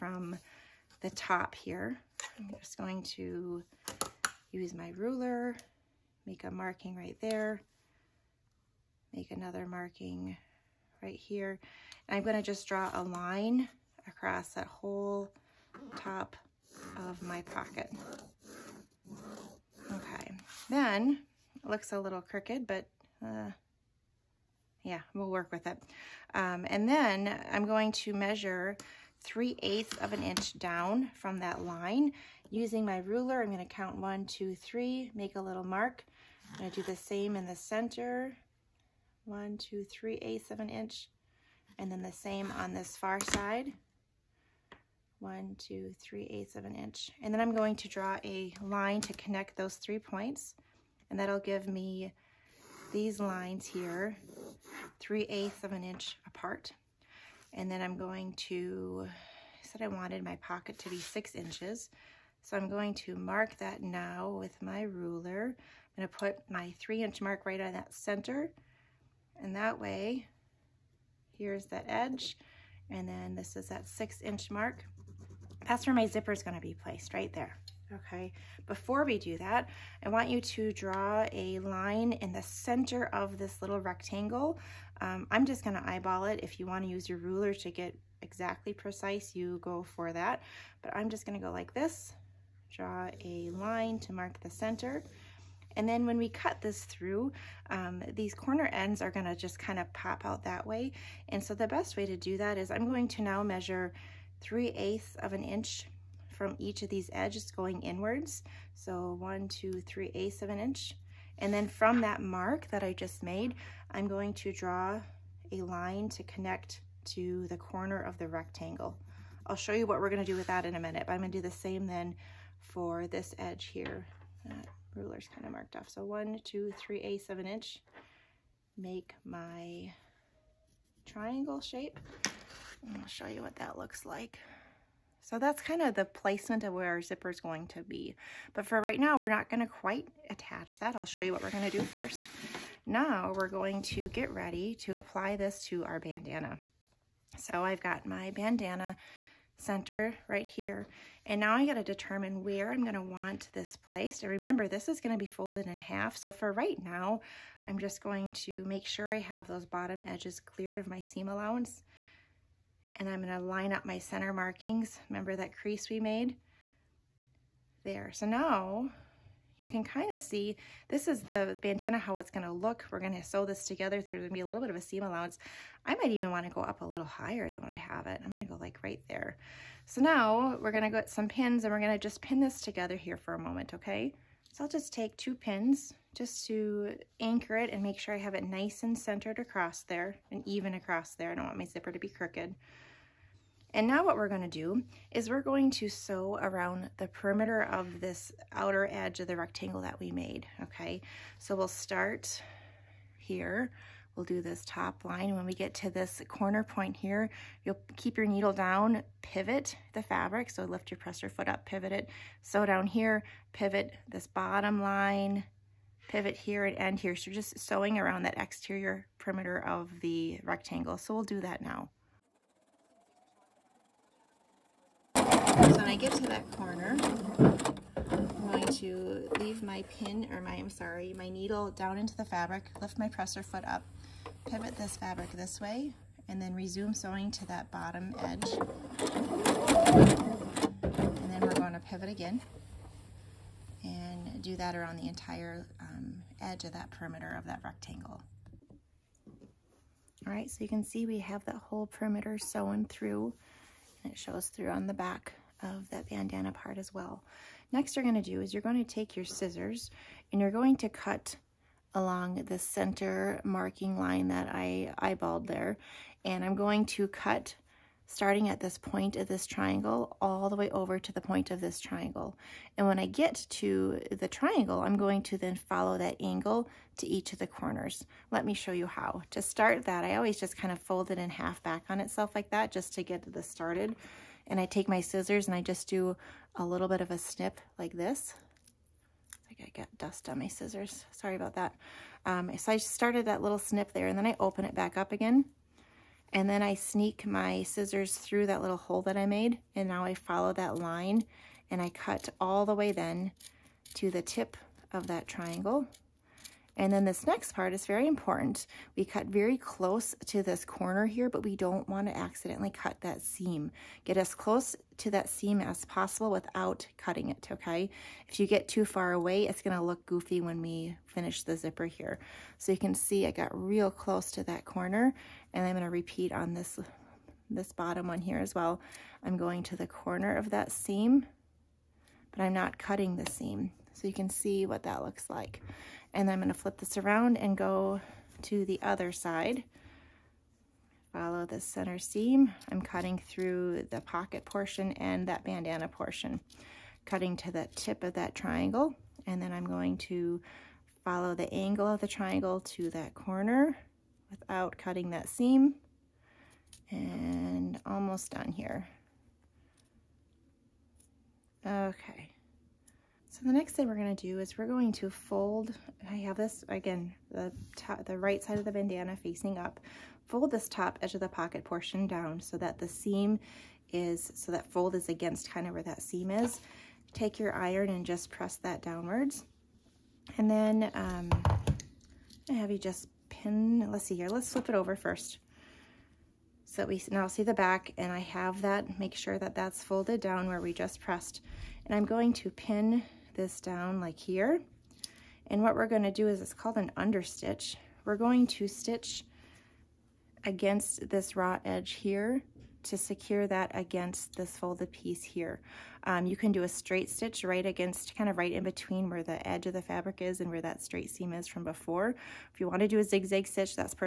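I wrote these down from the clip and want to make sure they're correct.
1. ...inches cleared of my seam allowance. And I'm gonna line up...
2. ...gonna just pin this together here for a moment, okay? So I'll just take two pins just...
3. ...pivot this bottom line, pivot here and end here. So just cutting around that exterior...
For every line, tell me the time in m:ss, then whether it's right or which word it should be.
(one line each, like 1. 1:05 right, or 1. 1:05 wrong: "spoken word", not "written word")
1. 2:40 wrong: "edges", not "inches"
2. 3:01 right
3. 3:33 wrong: "sewing", not "cutting".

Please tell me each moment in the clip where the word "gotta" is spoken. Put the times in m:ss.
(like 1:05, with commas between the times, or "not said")
2:31, 4:49.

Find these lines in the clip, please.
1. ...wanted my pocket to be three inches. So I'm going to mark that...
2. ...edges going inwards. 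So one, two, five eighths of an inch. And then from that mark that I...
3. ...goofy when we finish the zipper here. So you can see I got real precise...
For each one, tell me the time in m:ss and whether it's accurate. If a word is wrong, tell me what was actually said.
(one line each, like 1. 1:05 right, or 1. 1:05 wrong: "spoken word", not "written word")
1. 0:59 wrong: "six", not "three"
2. 1:47 wrong: "three", not "five"
3. 5:20 wrong: "close", not "precise".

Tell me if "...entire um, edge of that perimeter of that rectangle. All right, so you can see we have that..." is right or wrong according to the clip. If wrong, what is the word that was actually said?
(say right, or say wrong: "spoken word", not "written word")
right.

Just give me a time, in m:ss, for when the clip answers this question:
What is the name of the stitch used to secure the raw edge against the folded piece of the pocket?
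6:36.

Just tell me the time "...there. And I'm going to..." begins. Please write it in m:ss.
4:25.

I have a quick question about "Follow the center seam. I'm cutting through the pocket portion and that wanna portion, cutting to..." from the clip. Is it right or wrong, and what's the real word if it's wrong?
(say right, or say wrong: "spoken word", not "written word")
wrong: "bandana", not "wanna".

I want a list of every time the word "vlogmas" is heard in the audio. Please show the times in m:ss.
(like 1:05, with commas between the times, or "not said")
not said.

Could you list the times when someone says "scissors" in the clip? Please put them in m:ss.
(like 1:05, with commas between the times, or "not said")
4:19, 4:45, 4:50, 4:57.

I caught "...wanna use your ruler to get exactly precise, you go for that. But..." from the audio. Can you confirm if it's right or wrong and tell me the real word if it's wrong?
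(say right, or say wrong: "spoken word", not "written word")
right.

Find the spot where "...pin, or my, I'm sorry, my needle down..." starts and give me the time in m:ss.
3:49.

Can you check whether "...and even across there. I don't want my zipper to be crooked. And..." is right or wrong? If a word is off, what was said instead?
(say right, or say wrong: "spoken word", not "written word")
right.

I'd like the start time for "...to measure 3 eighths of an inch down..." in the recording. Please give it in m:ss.
0:27.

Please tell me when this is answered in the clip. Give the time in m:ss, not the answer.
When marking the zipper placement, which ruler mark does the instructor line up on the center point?
1:06.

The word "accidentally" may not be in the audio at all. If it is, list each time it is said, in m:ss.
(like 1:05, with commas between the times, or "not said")
5:12.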